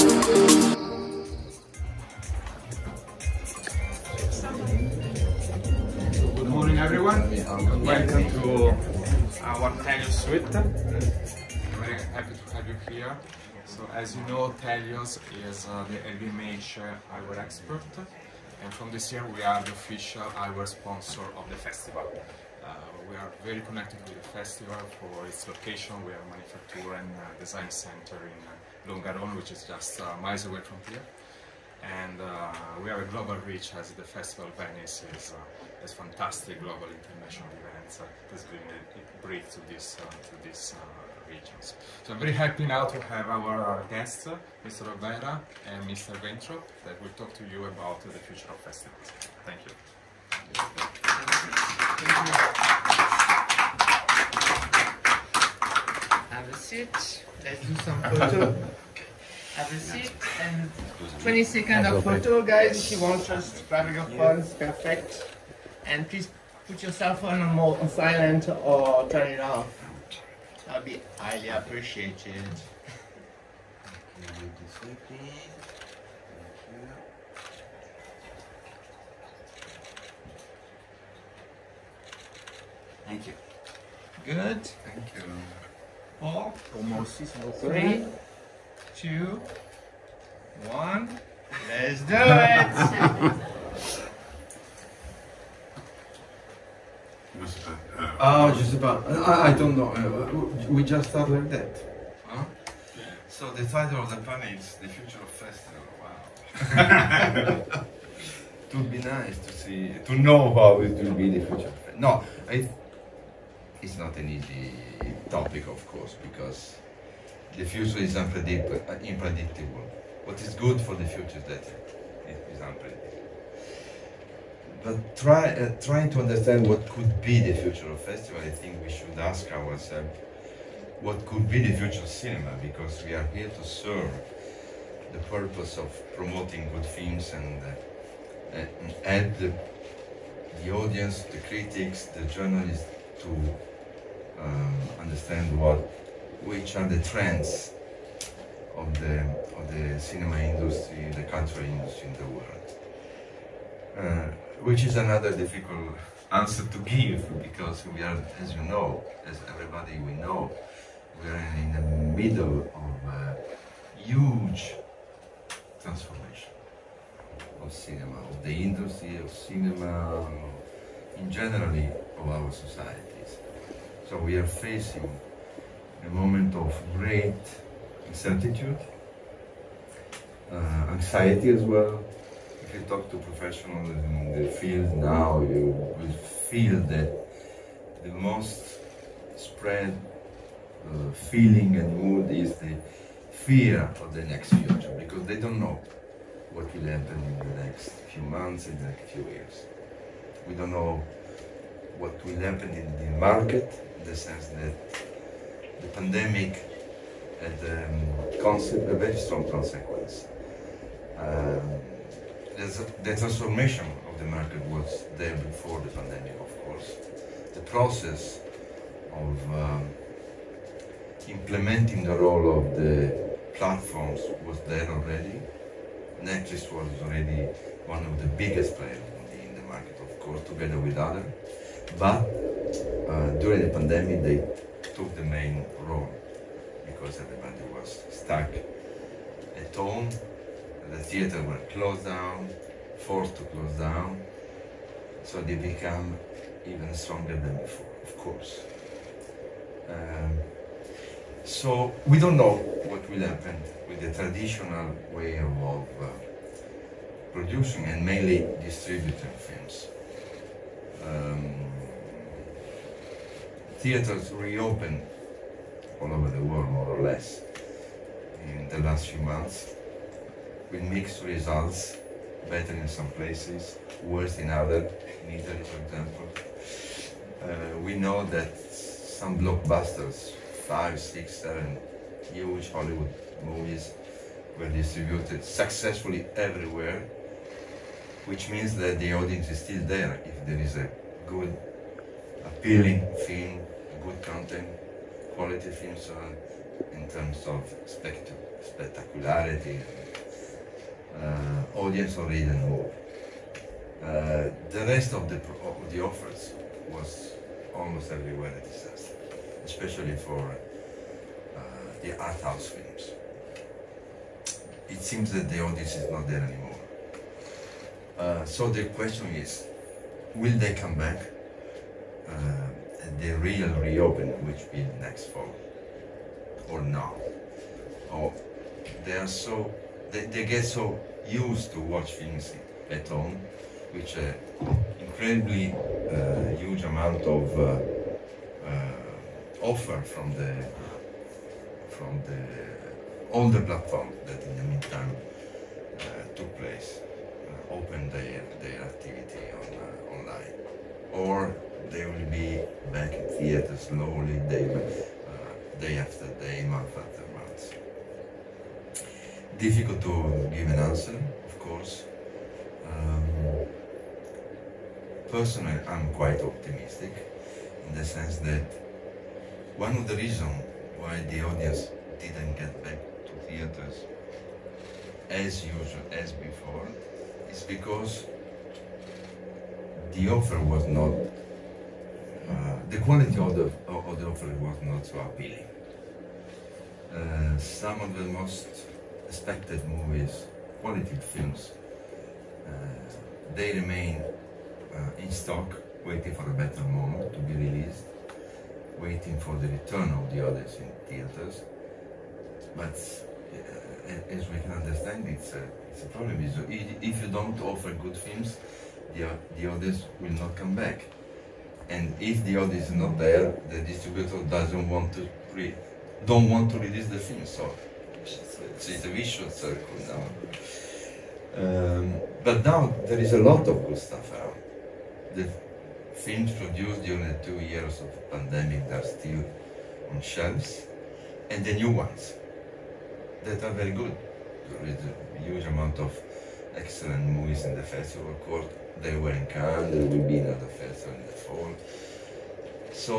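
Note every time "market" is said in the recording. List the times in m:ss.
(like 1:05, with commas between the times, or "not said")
3:23, 3:34, 3:49.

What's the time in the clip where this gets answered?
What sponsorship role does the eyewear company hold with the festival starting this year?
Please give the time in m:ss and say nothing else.
0:19.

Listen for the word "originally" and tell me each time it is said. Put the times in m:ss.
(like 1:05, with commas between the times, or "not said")
not said.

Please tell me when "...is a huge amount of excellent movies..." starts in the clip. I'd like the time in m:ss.
7:14.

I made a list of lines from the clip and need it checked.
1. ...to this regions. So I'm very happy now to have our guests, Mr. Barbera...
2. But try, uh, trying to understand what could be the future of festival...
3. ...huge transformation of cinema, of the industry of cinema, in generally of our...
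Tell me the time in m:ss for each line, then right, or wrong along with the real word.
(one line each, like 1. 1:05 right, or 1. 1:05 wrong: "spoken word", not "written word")
1. 0:39 right
2. 2:04 right
3. 2:43 right.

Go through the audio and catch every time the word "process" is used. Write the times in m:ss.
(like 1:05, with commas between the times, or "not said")
3:37.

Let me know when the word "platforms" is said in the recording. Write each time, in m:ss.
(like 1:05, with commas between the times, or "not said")
3:43, 5:43.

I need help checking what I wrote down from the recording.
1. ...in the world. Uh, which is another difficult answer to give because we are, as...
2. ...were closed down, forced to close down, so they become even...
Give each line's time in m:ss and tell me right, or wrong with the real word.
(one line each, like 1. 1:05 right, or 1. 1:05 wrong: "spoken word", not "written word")
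1. 2:32 right
2. 4:01 right.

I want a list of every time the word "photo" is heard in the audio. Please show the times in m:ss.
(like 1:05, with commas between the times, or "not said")
0:58, 1:02.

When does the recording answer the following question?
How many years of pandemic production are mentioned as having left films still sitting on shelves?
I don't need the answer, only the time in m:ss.
7:07.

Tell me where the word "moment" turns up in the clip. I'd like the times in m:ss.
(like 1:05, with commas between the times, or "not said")
2:56, 6:36.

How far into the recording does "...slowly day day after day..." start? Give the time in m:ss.
5:53.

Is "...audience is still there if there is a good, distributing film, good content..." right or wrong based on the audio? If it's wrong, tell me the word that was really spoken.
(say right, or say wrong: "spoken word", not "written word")
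wrong: "appealing", not "distributing".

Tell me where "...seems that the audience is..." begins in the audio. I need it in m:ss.
5:15.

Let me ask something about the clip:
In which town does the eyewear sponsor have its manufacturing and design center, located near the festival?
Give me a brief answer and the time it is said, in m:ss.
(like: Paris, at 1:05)
Longarone, at 0:28.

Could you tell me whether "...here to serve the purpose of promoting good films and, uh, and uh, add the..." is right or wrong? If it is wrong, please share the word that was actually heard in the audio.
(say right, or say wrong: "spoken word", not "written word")
right.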